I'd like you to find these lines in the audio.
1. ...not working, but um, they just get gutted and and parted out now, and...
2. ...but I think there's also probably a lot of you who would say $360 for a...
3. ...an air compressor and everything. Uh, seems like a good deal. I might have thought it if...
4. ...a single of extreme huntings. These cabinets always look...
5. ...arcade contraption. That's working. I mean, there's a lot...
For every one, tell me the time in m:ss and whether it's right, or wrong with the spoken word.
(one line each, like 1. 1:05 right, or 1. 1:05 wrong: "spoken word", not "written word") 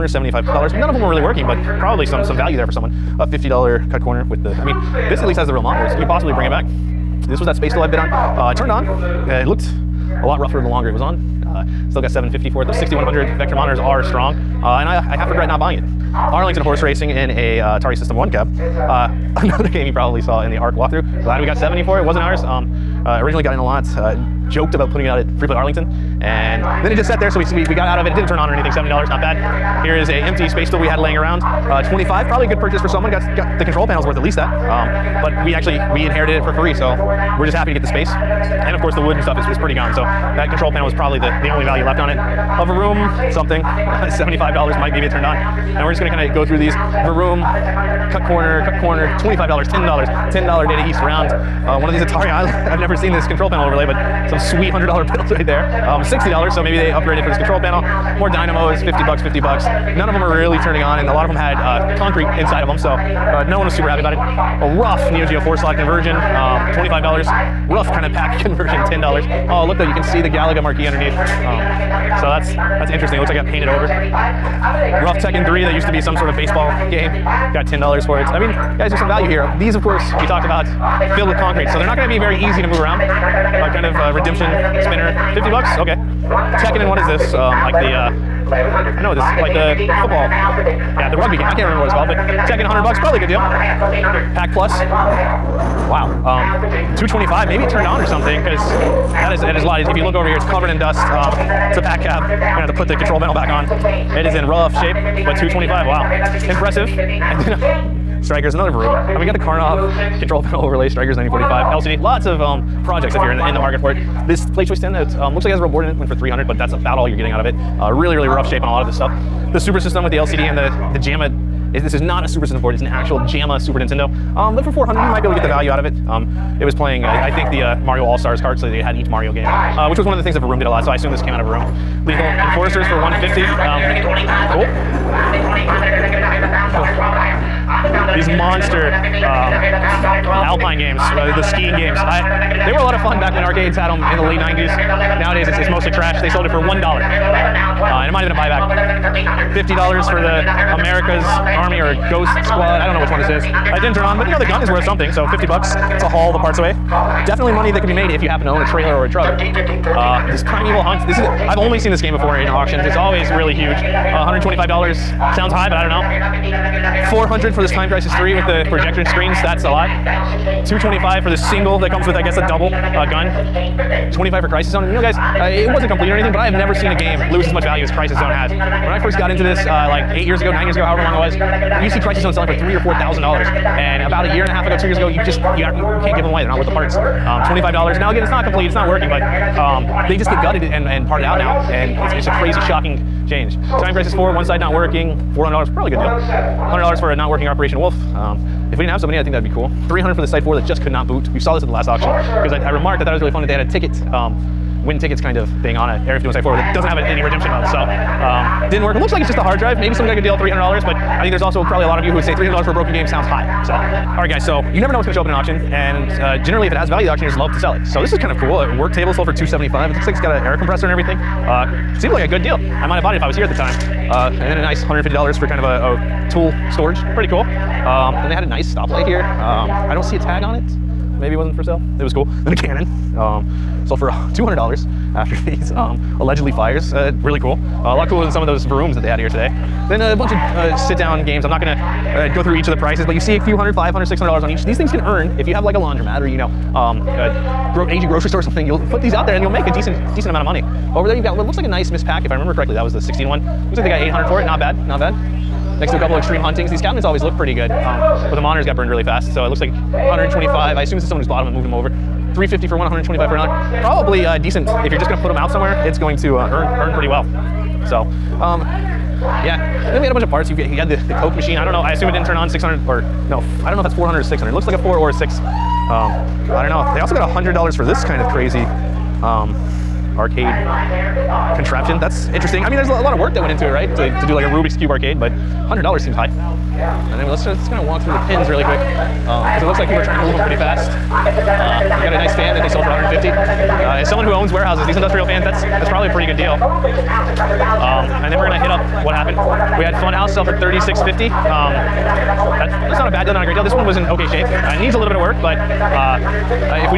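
1. 3:08 right
2. 3:30 wrong: "300", not "360"
3. 3:40 wrong: "bought", not "thought"
4. 4:15 wrong: "couple", not "single"
5. 4:40 wrong: "interesting", not "working".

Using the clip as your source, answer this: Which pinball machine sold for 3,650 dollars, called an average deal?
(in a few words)
Funhouse.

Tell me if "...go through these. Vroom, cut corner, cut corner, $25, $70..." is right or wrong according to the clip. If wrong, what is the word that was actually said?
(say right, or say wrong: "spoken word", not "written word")
wrong: "10", not "70".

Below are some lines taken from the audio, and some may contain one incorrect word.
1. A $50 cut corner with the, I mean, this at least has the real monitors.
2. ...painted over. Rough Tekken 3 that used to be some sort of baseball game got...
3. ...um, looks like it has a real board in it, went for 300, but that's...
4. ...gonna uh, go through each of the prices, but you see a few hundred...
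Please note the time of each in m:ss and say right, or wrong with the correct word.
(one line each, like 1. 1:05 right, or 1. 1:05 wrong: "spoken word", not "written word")
1. 0:03 right
2. 1:13 right
3. 1:55 right
4. 4:01 right.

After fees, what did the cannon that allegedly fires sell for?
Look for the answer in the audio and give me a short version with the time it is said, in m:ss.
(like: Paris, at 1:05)
$200, at 3:54.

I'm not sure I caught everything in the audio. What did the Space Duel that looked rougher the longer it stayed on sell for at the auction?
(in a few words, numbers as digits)
$750.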